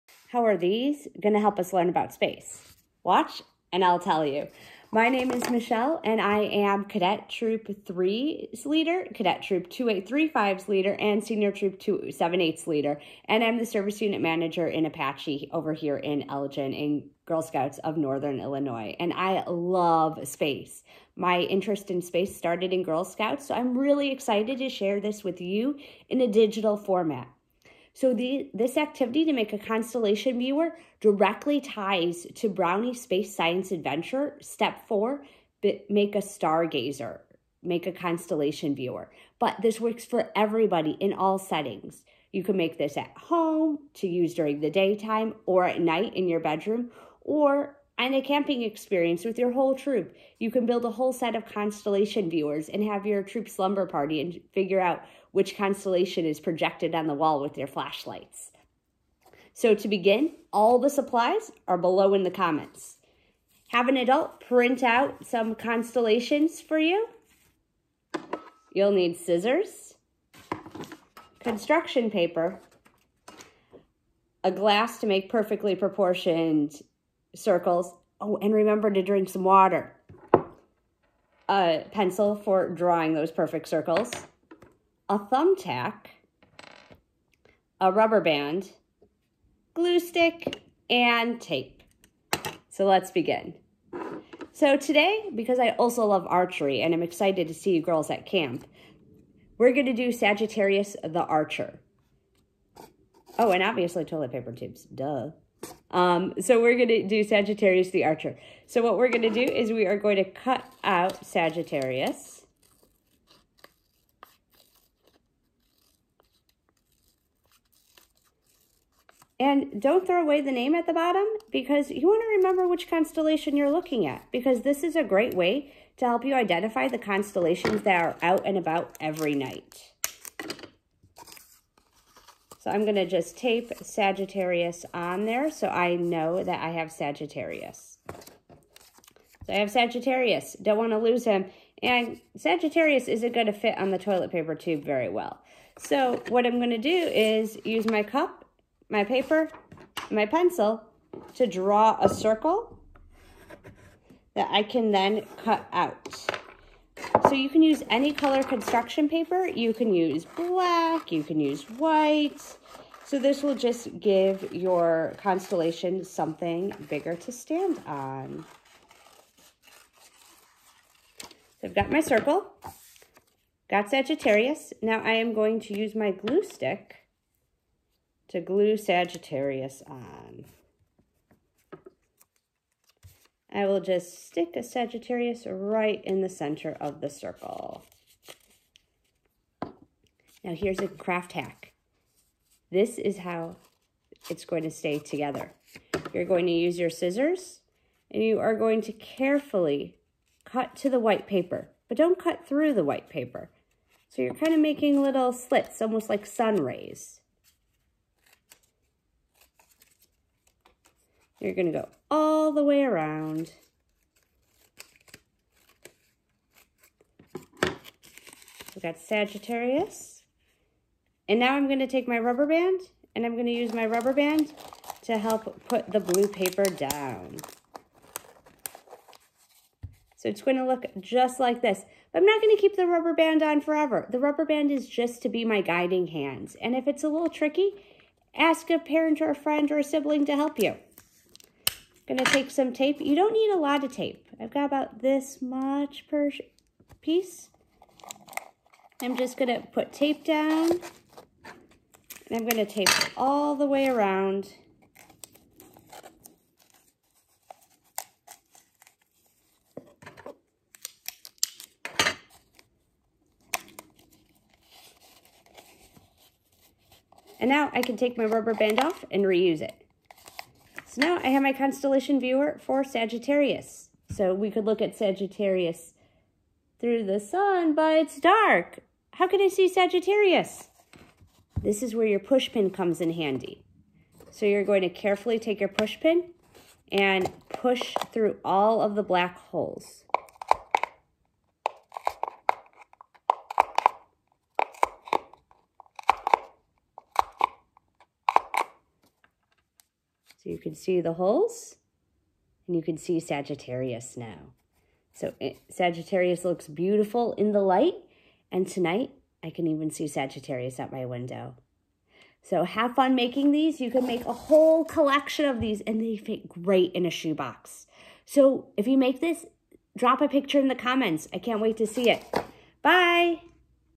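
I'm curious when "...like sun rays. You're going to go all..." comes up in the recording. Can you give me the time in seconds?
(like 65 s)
206 s.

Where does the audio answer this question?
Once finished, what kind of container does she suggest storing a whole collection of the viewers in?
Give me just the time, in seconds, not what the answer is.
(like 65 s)
317 s.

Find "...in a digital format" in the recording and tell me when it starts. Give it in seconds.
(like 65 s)
26 s.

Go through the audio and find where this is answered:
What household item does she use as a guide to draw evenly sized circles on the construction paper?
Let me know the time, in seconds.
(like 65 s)
74 s.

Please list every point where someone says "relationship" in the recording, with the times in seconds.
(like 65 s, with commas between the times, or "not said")
not said.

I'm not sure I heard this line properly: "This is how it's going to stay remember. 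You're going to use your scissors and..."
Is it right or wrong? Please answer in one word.
wrong.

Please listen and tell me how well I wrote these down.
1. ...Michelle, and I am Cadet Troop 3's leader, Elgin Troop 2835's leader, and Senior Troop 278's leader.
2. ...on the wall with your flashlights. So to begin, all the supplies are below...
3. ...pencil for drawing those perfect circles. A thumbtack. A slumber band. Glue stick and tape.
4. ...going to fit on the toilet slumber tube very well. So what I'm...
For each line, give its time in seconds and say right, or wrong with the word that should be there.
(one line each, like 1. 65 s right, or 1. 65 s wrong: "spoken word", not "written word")
1. 5 s wrong: "Cadet", not "Elgin"
2. 56 s right
3. 81 s wrong: "rubber", not "slumber"
4. 143 s wrong: "paper", not "slumber".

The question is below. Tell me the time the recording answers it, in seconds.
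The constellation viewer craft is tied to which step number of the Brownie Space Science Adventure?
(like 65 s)
34 s.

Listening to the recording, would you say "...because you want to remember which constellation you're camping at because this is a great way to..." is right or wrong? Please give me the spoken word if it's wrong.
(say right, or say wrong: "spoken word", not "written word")
wrong: "looking", not "camping".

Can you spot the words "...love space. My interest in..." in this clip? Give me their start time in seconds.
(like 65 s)
19 s.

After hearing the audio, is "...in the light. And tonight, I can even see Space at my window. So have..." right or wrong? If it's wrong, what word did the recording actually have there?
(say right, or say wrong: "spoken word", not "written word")
wrong: "Sagittarius", not "Space".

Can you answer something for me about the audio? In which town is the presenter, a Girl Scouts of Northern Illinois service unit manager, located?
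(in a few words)
Elgin.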